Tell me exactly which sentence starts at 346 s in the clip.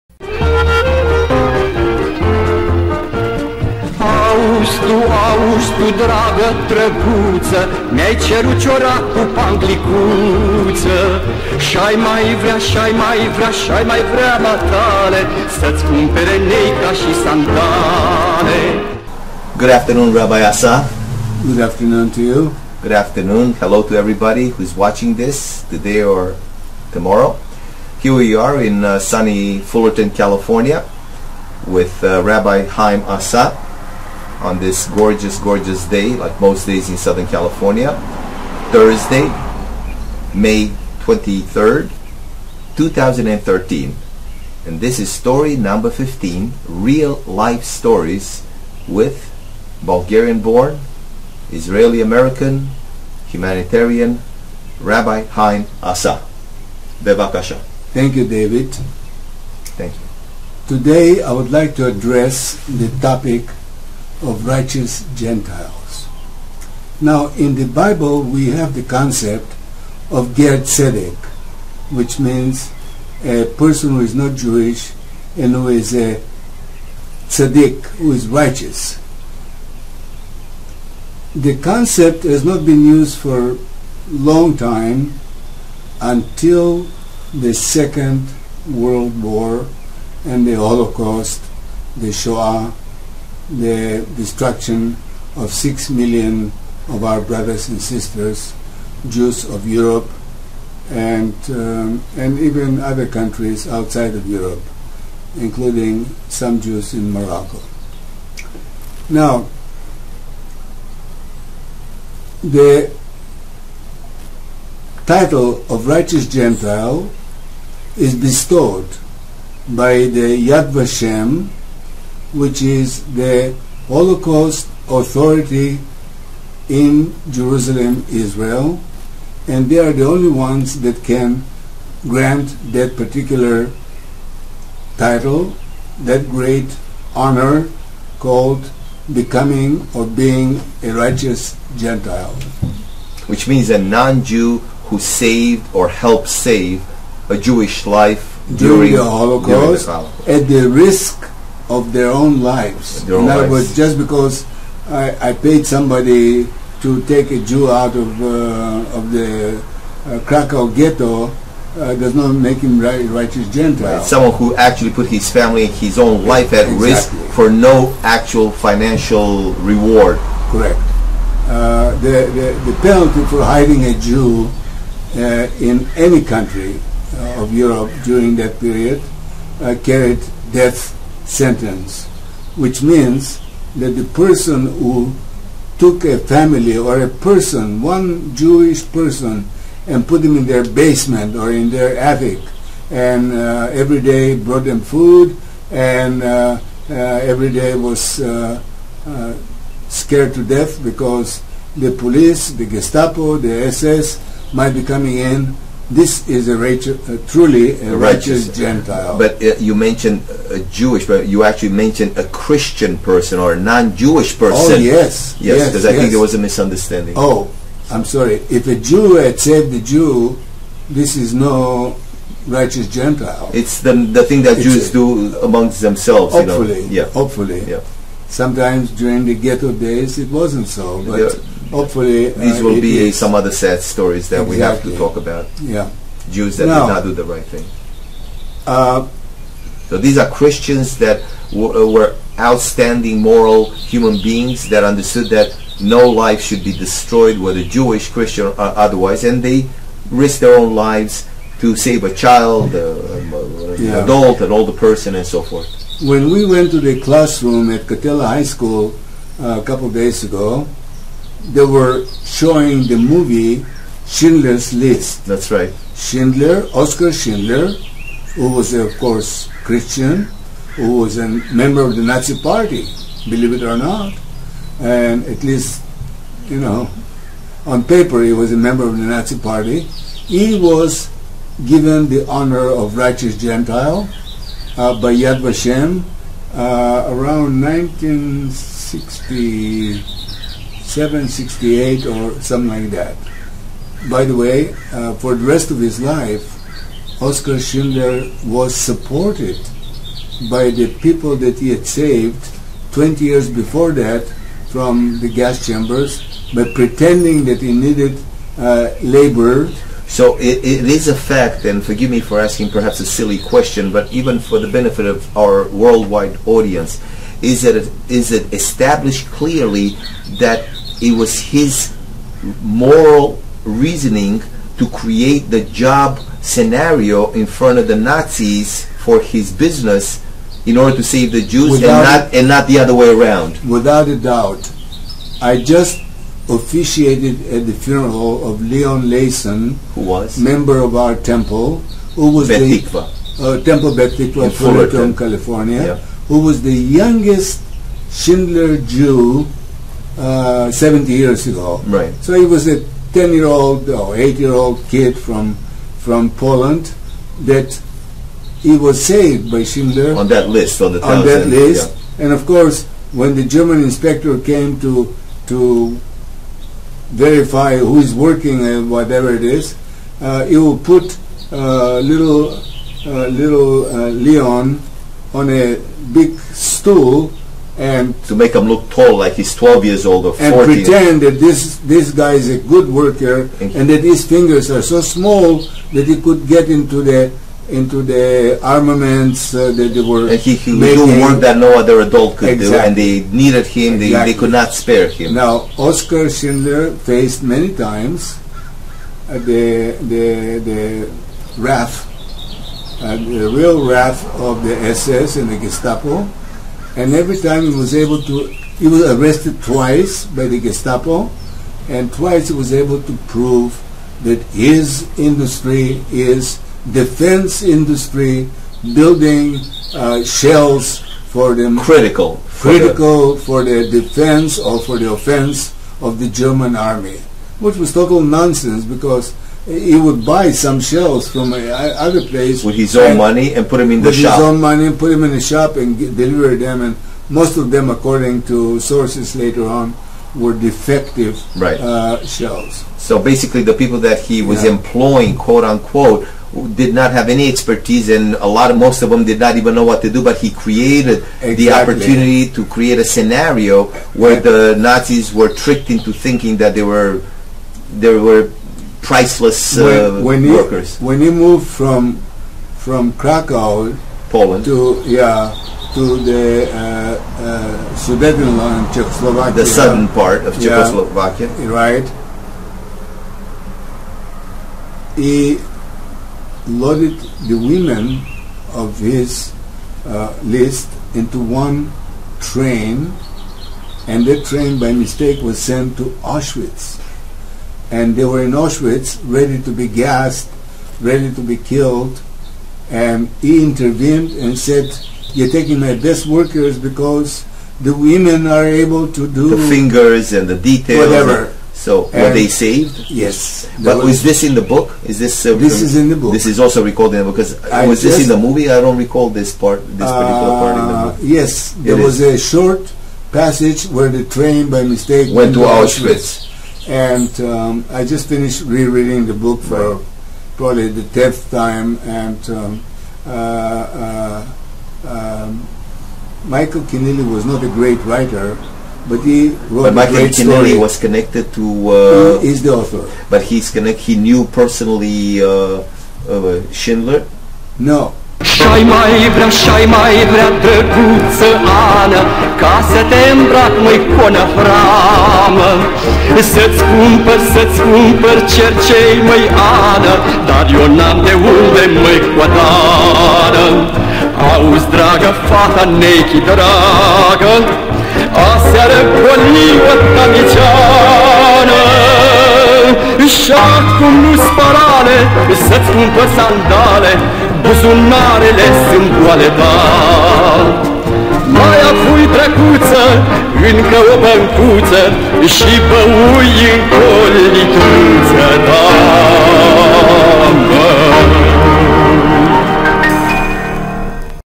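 who was the youngest Schindler Jew uh, 70 years ago.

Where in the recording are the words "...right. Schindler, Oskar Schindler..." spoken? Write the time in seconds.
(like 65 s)
265 s.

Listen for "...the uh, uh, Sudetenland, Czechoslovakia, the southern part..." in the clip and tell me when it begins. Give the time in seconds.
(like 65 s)
466 s.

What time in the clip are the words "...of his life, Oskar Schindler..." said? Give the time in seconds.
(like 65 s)
295 s.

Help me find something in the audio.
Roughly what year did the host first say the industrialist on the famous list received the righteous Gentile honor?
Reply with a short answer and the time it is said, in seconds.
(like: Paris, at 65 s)
1960, at 287 s.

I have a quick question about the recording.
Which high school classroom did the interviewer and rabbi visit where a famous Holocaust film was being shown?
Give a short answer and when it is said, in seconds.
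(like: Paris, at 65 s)
Catella High School, at 257 s.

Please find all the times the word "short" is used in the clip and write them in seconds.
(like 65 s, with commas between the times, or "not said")
512 s.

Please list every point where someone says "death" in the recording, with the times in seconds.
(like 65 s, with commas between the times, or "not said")
180 s, 200 s.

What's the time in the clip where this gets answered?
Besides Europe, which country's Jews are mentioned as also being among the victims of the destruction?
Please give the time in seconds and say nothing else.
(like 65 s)
107 s.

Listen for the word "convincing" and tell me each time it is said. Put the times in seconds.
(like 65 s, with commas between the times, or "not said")
not said.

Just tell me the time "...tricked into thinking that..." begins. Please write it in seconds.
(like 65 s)
455 s.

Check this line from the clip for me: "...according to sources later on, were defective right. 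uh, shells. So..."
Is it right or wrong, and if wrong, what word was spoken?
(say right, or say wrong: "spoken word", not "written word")
right.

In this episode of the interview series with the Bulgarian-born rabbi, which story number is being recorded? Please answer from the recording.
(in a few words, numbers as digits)
15.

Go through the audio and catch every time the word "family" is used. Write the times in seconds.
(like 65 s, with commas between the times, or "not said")
165 s, 186 s.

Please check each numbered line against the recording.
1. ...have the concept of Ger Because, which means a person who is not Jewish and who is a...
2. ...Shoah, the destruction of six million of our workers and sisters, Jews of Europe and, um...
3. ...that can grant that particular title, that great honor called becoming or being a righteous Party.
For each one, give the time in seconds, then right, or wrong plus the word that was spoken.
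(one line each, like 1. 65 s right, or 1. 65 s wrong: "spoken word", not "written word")
1. 68 s wrong: "Tzedek", not "Because"
2. 92 s wrong: "brothers", not "workers"
3. 130 s wrong: "Gentile", not "Party".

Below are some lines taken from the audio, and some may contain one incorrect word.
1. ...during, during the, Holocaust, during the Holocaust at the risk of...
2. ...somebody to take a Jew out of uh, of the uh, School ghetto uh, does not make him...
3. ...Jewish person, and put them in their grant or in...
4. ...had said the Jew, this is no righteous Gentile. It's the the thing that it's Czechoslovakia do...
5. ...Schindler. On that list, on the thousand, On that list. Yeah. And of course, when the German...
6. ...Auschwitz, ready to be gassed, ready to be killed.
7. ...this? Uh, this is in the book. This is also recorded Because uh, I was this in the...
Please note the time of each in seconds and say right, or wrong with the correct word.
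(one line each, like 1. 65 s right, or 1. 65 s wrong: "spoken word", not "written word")
1. 148 s right
2. 155 s wrong: "Krakow", not "School"
3. 188 s wrong: "basement", not "grant"
4. 219 s wrong: "Jews", not "Czechoslovakia"
5. 359 s right
6. 488 s right
7. 505 s right.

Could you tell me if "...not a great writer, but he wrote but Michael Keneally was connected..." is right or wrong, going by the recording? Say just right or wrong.
right.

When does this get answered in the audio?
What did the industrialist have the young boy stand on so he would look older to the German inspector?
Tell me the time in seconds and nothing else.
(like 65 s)
376 s.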